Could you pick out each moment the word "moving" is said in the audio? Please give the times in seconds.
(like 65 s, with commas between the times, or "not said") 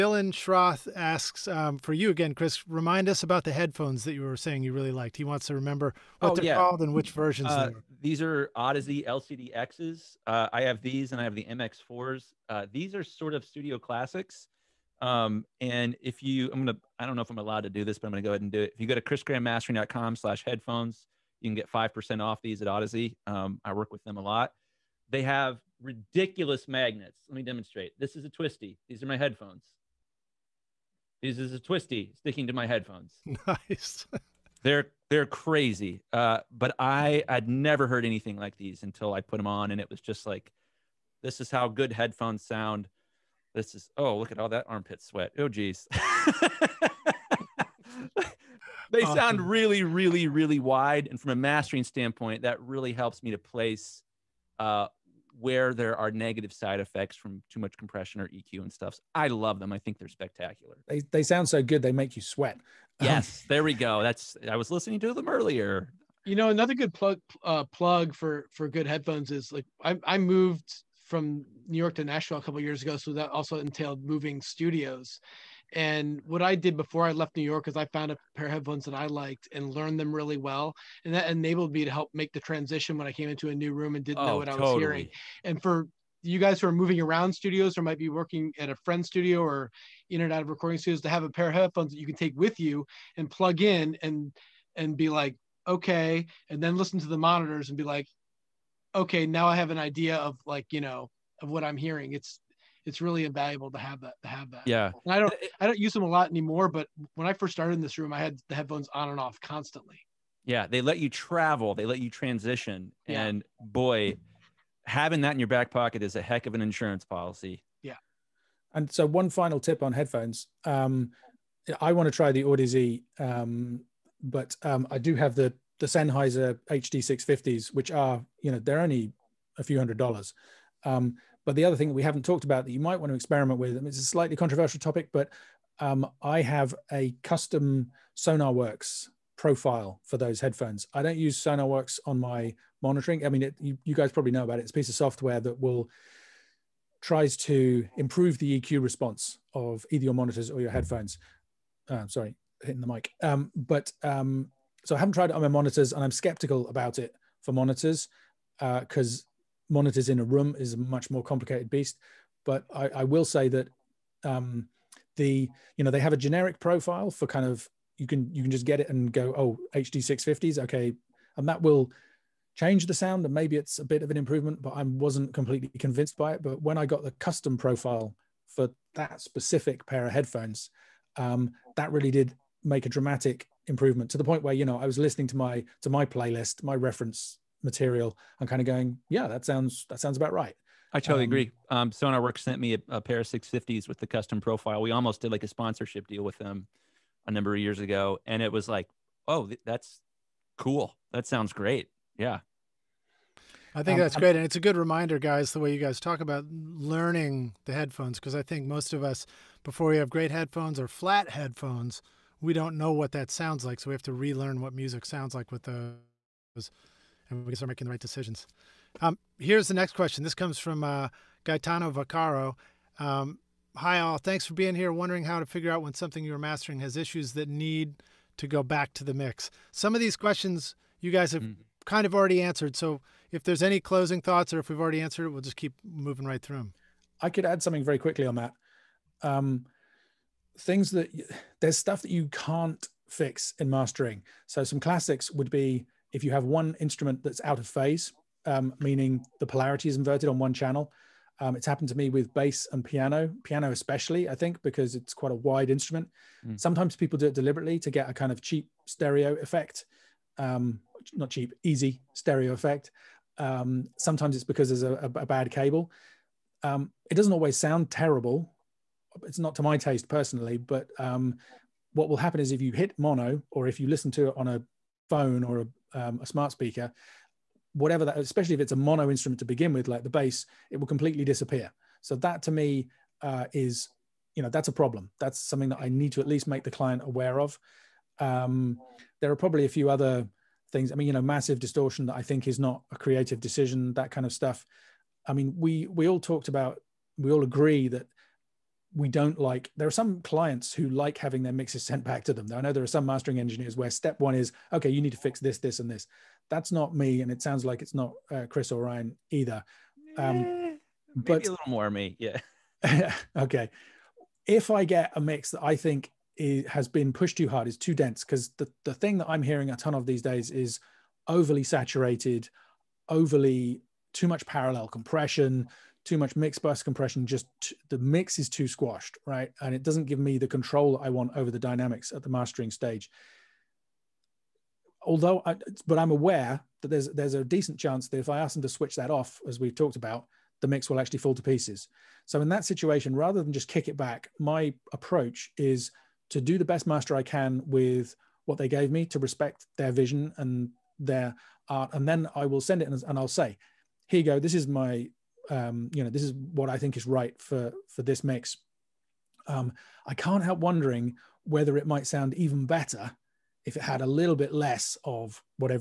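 74 s, 86 s, 235 s.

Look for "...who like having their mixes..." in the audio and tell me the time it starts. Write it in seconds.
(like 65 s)
300 s.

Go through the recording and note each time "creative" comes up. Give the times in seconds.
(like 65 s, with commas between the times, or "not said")
292 s.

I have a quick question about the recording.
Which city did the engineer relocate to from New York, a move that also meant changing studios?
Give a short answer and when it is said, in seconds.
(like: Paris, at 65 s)
Nashville, at 72 s.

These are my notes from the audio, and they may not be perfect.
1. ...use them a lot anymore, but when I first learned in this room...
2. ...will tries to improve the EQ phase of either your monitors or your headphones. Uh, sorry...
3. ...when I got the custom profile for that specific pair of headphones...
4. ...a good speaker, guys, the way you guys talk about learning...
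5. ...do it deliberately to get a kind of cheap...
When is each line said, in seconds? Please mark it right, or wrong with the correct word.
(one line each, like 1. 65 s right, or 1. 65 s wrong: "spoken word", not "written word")
1. 105 s wrong: "started", not "learned"
2. 145 s wrong: "response", not "phase"
3. 176 s right
4. 204 s wrong: "reminder", not "speaker"
5. 257 s right.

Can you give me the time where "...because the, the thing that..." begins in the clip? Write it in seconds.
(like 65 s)
318 s.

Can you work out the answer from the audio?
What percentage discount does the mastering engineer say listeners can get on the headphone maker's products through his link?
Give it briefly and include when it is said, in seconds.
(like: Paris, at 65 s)
5%, at 21 s.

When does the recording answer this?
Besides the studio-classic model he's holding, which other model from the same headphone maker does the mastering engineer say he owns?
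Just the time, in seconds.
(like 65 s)
11 s.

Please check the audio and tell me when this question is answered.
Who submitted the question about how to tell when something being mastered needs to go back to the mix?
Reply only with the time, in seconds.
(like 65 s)
221 s.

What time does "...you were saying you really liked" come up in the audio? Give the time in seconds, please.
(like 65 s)
4 s.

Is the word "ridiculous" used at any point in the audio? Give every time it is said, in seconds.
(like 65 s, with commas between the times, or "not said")
25 s.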